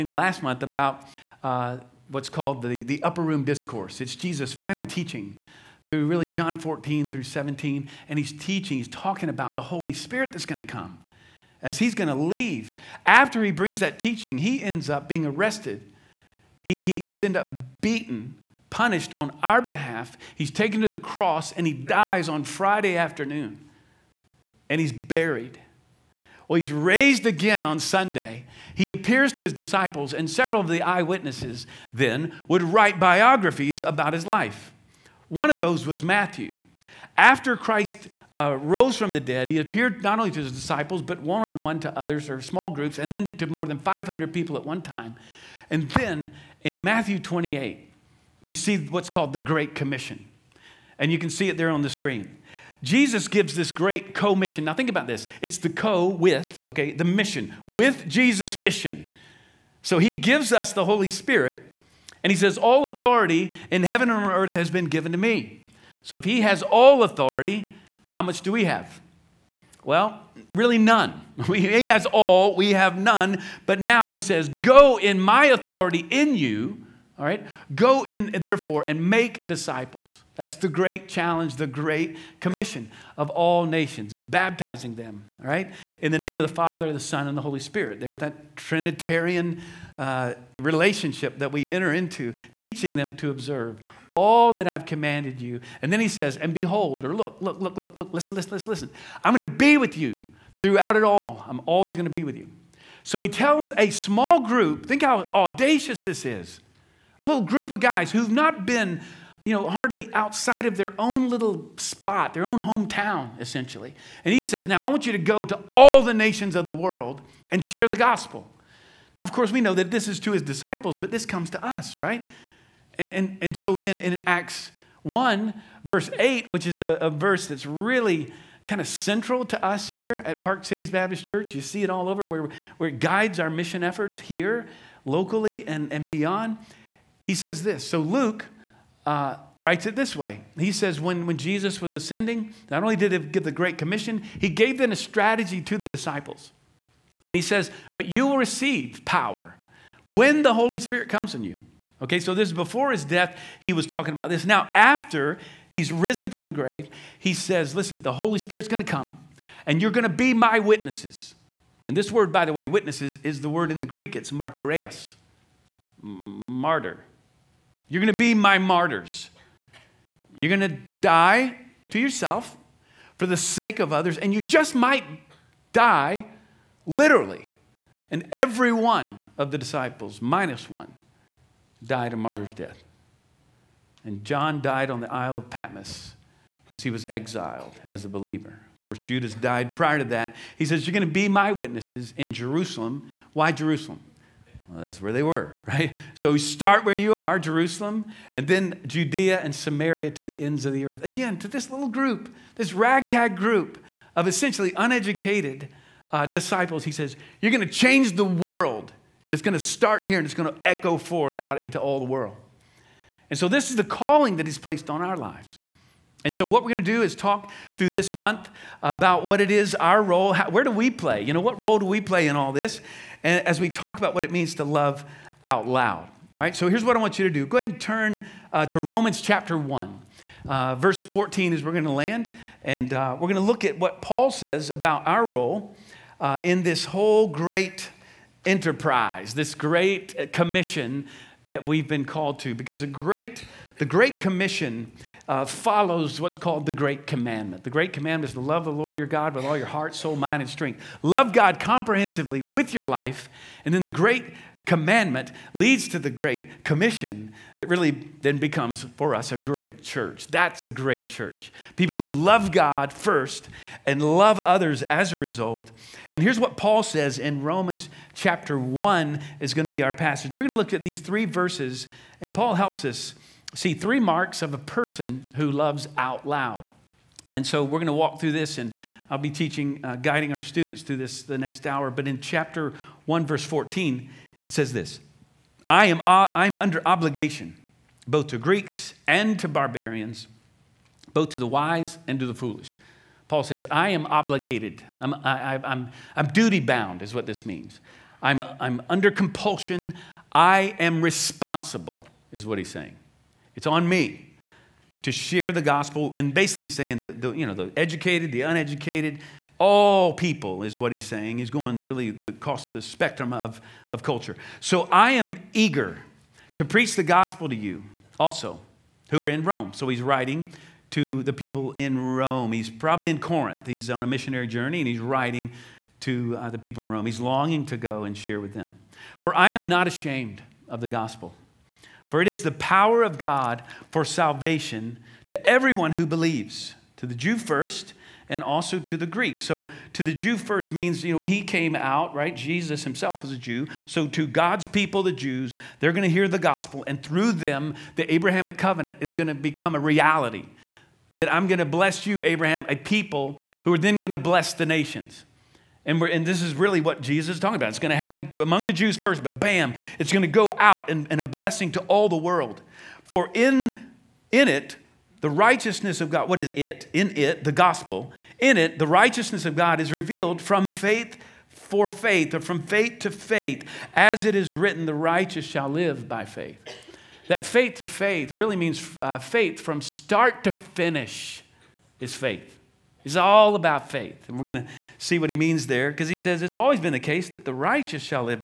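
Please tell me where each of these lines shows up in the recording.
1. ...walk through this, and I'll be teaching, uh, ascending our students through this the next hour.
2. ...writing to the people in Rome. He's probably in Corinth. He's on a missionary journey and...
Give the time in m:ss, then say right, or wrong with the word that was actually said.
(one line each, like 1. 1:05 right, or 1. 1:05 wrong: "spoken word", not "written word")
1. 4:37 wrong: "guiding", not "ascending"
2. 5:20 right.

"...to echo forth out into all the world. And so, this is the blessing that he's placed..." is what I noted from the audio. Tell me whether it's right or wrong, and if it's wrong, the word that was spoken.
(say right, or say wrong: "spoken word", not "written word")
wrong: "calling", not "blessing".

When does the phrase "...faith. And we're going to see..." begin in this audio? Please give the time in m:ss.
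6:23.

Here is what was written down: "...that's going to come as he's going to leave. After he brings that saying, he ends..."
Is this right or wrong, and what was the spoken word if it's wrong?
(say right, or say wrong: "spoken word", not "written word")
wrong: "teaching", not "saying".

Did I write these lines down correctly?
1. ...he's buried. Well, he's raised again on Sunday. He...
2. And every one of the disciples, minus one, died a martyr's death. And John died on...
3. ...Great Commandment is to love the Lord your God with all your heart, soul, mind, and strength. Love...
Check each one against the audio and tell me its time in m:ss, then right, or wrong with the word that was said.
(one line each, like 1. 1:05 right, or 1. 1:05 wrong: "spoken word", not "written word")
1. 0:24 right
2. 2:58 right
3. 4:07 right.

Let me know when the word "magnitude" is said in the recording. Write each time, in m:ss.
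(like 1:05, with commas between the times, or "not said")
not said.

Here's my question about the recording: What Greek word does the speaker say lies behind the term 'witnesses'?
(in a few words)
martyreus.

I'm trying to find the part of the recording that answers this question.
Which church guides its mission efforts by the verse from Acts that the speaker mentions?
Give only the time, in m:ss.
2:10.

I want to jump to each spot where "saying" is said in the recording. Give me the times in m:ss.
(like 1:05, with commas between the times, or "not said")
5:02, 5:06, 5:11.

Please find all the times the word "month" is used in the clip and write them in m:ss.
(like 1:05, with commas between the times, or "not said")
0:00, 3:38.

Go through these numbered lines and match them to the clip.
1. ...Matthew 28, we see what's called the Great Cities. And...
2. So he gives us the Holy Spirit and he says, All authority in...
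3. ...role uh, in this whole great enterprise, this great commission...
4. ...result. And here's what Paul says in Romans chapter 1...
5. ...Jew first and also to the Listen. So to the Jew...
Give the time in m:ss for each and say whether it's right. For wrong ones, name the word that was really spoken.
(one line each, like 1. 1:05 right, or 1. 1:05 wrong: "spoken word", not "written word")
1. 0:46 wrong: "Commission", not "Cities"
2. 0:59 right
3. 3:55 right
4. 4:25 right
5. 5:37 wrong: "Greek", not "Listen".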